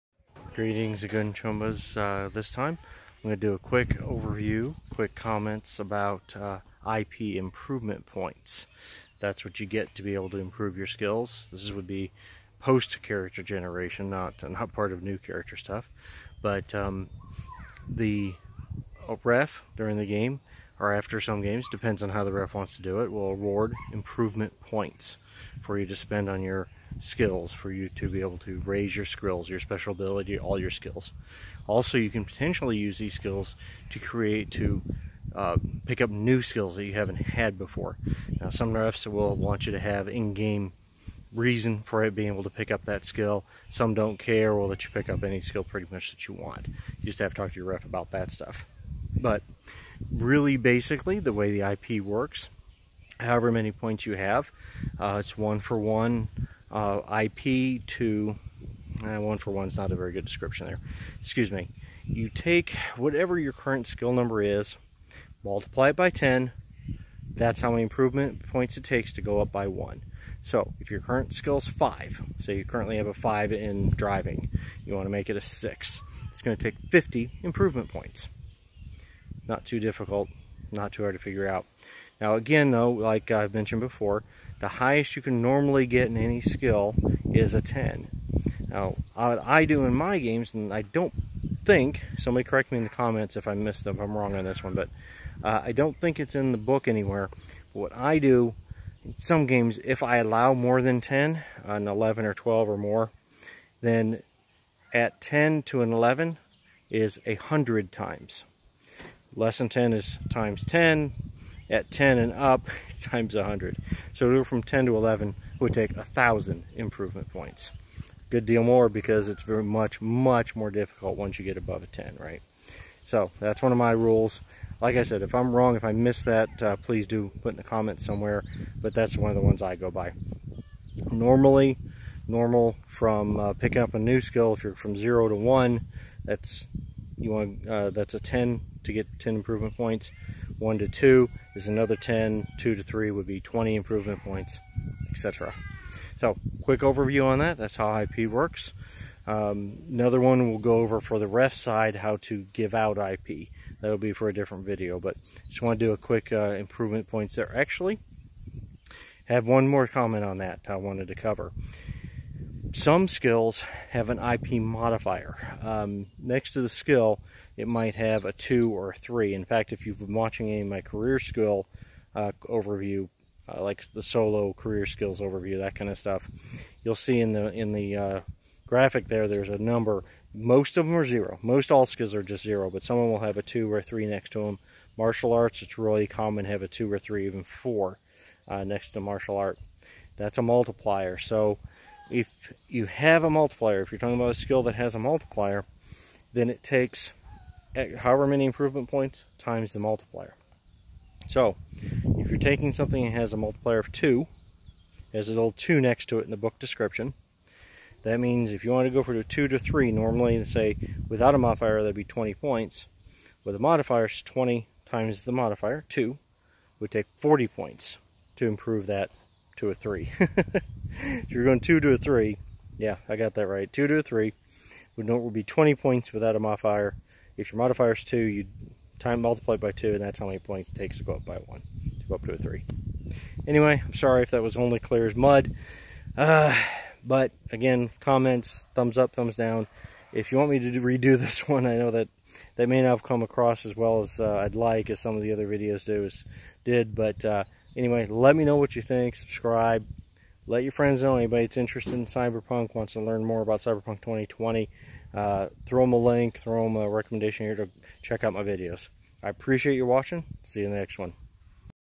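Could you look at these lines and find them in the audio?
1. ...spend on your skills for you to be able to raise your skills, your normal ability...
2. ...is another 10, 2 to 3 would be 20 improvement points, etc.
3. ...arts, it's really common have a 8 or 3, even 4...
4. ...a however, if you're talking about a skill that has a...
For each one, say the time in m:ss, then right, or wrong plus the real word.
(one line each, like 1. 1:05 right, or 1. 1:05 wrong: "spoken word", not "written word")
1. 0:25 wrong: "special", not "normal"
2. 2:21 right
3. 3:05 wrong: "2", not "8"
4. 3:13 wrong: "multiplier", not "however".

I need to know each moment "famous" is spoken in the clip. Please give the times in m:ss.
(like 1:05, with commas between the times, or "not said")
not said.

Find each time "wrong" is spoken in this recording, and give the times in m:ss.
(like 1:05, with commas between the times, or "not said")
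1:34, 2:05.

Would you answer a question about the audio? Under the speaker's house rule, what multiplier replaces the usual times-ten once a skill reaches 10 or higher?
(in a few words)
100.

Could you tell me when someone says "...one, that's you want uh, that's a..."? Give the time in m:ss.
2:15.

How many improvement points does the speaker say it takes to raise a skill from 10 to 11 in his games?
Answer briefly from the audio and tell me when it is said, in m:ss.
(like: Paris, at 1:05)
1,000, at 1:55.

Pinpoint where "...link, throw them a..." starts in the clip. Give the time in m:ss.
4:15.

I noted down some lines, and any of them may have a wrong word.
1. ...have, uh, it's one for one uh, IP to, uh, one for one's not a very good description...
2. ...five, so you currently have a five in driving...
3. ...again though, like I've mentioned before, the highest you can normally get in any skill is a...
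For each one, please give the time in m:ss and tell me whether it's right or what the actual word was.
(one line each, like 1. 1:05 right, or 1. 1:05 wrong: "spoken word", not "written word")
1. 0:54 right
2. 1:11 right
3. 1:22 right.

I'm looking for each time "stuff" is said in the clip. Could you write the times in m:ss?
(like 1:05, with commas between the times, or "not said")
0:15, 0:48, 2:55.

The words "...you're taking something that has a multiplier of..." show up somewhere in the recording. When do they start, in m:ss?
3:22.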